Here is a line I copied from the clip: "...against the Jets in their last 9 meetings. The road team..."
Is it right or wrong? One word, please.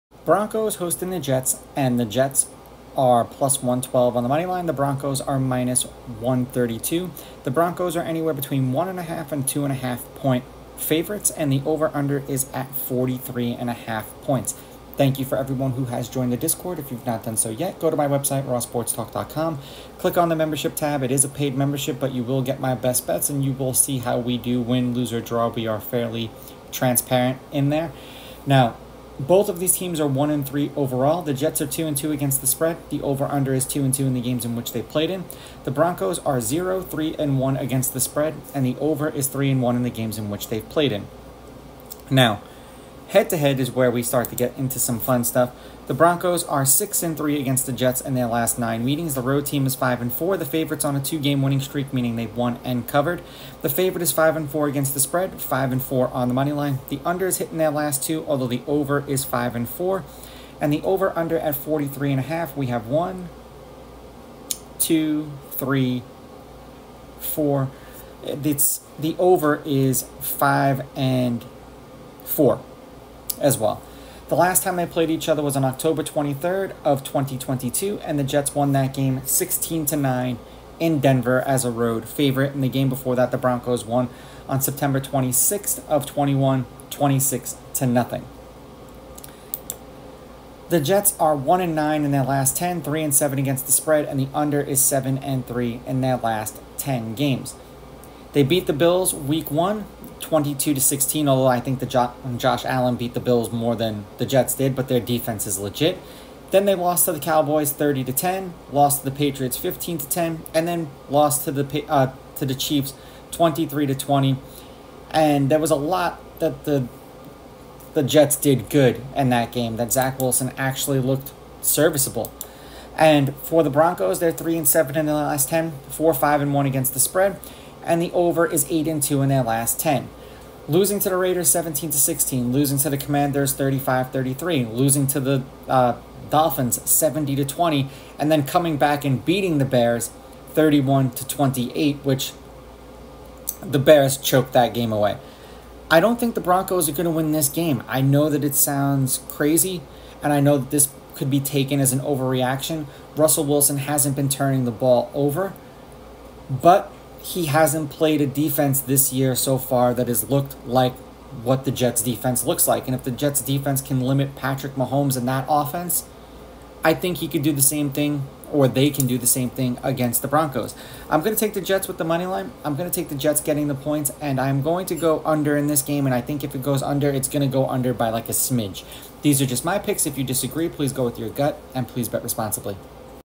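right.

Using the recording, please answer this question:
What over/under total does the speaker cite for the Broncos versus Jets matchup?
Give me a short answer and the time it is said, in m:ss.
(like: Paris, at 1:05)
43.5, at 0:12.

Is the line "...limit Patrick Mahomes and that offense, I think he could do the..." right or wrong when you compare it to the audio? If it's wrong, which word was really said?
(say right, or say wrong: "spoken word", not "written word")
right.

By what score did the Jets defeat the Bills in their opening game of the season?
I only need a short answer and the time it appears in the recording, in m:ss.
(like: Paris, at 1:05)
22 to 16, at 1:40.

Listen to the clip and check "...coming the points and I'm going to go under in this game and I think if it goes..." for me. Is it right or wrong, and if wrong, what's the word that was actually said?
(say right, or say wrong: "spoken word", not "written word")
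wrong: "getting", not "coming".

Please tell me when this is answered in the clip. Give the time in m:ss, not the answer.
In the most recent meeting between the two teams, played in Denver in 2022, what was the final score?
1:19.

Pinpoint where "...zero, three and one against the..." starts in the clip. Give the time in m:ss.
0:36.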